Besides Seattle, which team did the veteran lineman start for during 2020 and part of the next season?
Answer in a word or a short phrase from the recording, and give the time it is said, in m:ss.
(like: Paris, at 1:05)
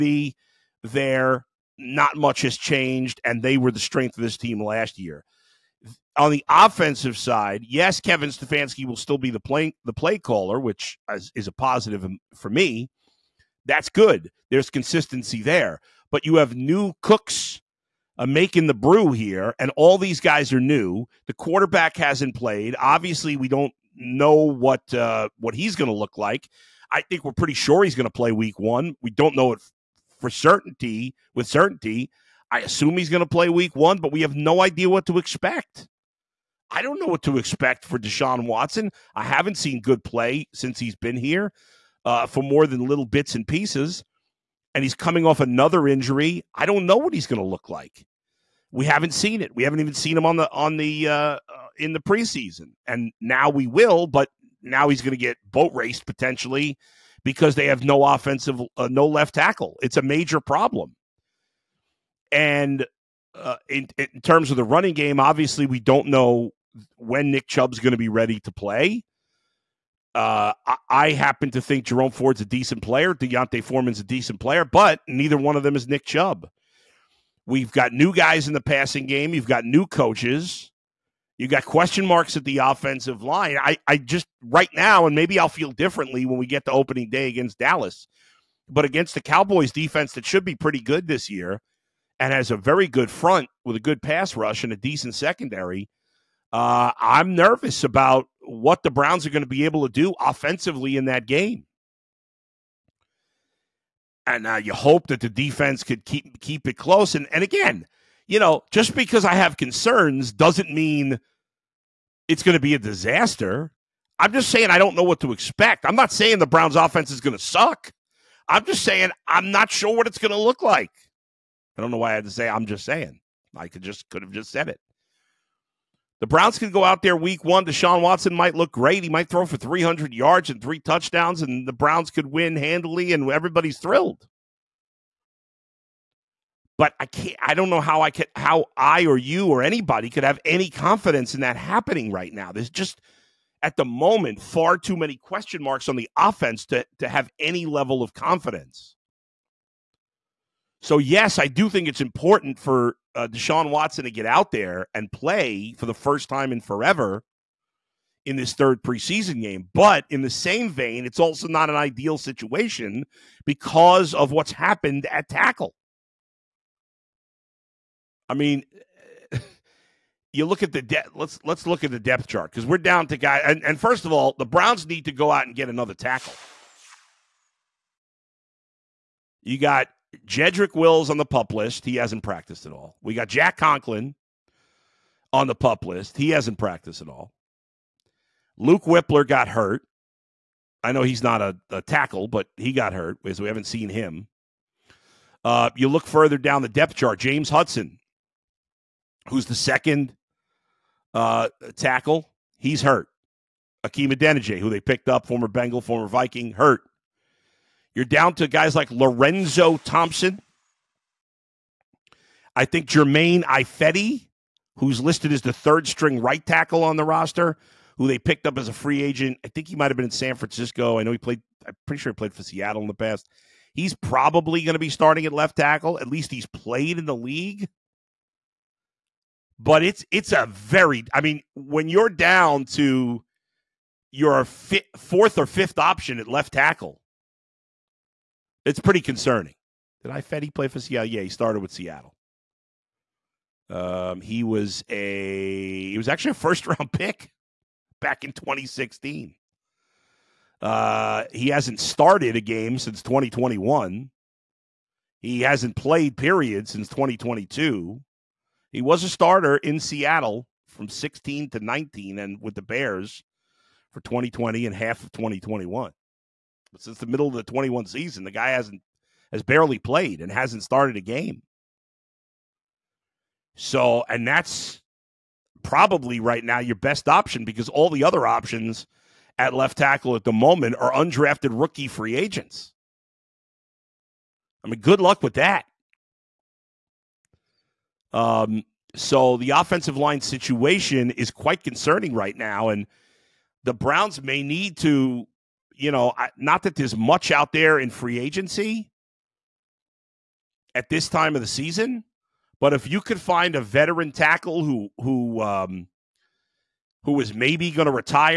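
the Bears, at 4:22.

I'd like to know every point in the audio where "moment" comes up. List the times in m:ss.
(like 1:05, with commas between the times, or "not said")
2:23, 4:40.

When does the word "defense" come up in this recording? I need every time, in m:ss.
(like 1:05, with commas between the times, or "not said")
1:29, 1:45.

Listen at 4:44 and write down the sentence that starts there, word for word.
I mean, good luck with that.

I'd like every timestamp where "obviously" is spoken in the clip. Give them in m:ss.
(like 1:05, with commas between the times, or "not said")
0:22, 1:05.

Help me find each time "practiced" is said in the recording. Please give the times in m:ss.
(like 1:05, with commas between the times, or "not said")
3:02, 3:06.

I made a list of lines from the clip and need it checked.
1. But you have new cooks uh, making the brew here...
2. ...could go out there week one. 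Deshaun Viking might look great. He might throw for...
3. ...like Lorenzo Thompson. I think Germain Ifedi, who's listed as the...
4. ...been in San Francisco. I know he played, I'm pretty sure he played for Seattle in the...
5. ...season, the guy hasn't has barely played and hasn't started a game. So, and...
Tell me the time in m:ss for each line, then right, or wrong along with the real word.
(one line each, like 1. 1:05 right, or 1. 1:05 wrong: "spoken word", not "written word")
1. 0:16 right
2. 2:06 wrong: "Watson", not "Viking"
3. 3:28 right
4. 3:39 right
5. 4:27 right.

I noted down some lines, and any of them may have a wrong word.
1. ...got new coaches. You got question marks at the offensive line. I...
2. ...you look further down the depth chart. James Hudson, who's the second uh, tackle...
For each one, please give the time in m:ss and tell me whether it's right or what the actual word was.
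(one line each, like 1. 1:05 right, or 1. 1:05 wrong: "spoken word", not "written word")
1. 1:19 right
2. 3:15 right.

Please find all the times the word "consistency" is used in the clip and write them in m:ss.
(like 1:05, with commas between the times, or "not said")
0:14.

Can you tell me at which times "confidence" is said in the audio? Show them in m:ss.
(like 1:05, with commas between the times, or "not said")
2:20, 2:28.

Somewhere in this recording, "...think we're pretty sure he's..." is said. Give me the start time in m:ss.
0:27.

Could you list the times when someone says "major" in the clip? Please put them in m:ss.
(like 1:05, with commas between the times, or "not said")
1:00.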